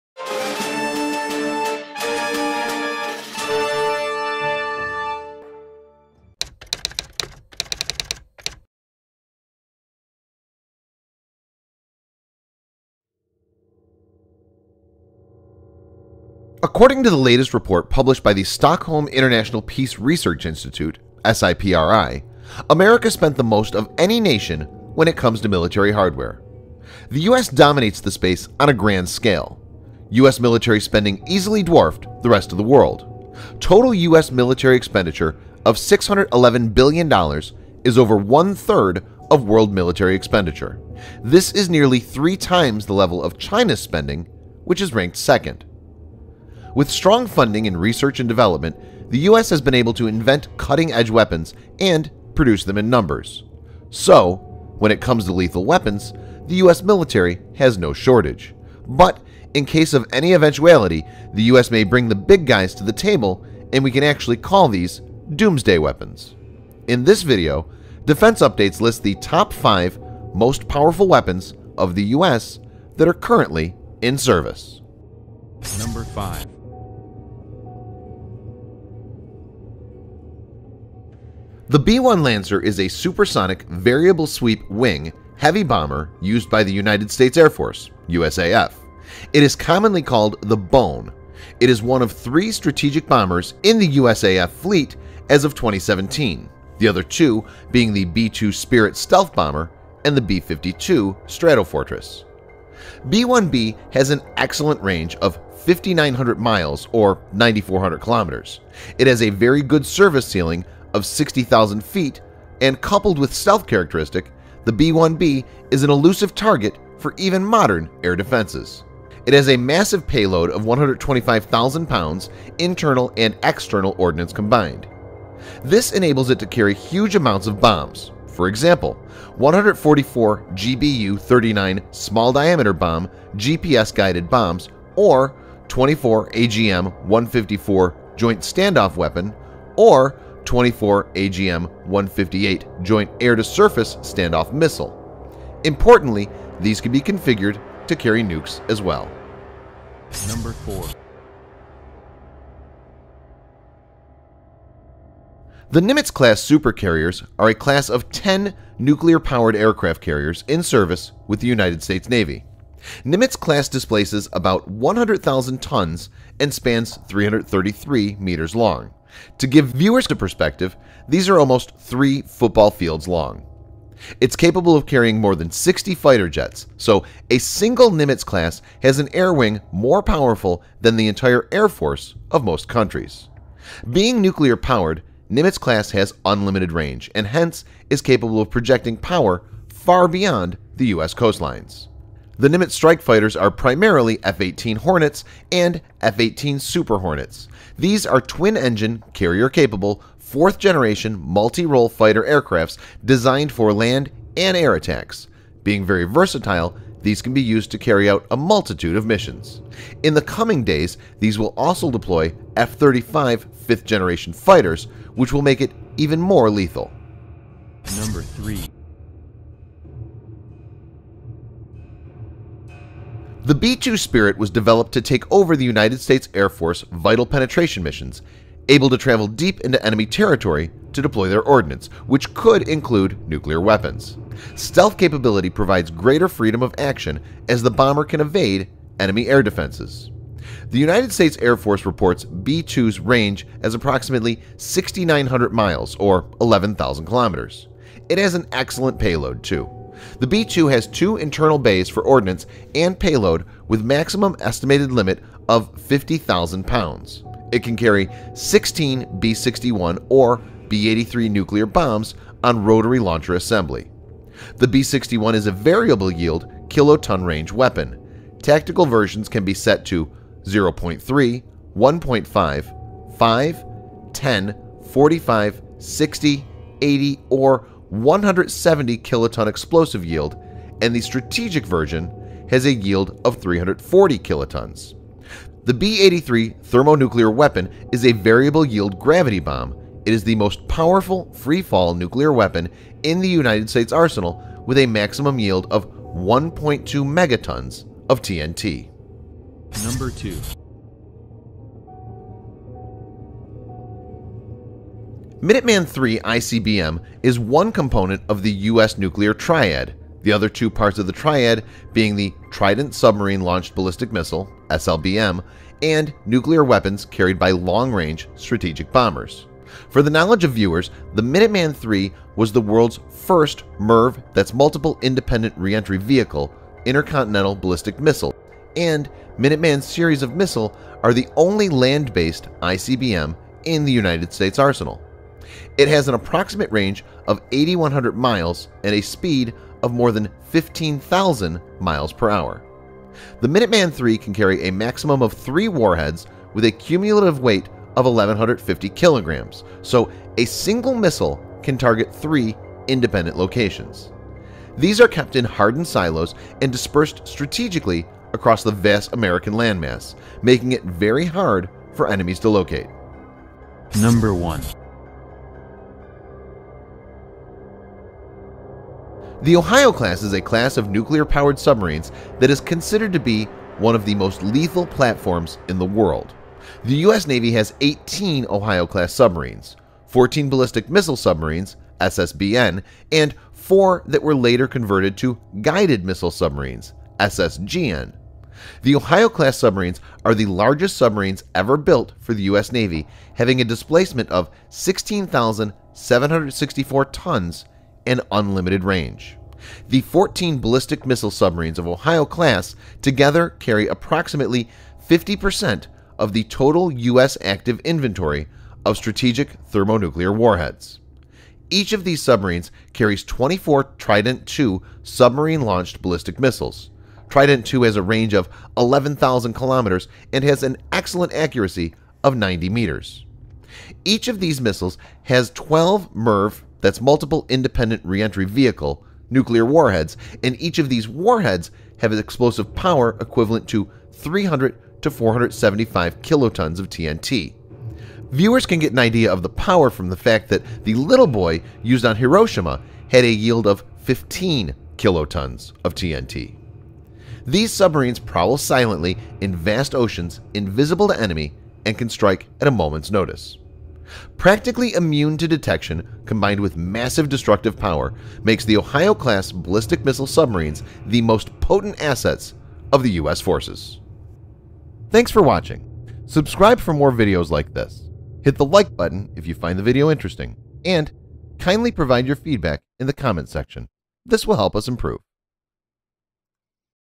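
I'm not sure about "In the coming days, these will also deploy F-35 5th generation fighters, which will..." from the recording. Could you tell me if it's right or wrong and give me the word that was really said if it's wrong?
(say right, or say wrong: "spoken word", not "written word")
right.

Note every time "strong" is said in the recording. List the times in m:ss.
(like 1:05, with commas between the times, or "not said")
0:46.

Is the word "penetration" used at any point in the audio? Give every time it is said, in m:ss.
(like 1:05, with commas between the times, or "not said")
3:47.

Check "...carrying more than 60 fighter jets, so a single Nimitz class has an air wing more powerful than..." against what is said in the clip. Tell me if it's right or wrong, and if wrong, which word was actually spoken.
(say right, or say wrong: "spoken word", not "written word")
right.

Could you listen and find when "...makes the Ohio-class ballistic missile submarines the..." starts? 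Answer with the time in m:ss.
7:38.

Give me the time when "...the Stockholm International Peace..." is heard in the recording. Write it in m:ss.
0:18.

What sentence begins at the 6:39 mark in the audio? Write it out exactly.
The 14 ballistic missile submarines of Ohio class together carry approximately 50% of the total U.S.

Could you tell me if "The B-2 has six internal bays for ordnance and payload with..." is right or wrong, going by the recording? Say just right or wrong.
wrong.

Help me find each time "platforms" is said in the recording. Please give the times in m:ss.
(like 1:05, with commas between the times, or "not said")
6:14.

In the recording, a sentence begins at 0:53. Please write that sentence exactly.
So, when it comes to lethal weapons, the US military has no shortage.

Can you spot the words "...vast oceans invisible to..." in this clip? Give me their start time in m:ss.
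7:29.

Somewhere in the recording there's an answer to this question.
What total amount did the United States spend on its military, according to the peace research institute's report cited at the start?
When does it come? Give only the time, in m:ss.
0:35.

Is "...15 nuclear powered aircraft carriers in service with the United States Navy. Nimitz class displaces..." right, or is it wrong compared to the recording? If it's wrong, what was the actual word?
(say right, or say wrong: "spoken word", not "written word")
wrong: "10", not "15".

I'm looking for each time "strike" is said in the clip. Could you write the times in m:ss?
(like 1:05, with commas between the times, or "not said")
3:12, 7:32.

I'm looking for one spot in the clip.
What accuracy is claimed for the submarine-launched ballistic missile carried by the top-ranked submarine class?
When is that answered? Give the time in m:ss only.
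7:02.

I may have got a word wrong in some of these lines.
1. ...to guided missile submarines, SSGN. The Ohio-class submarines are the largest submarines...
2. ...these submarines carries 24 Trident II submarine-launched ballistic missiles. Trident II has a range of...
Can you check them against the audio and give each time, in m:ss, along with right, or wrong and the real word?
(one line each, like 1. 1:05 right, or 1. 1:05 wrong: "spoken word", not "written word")
1. 6:25 right
2. 6:52 right.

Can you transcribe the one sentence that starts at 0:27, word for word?
The US dominates the space on a grand scale.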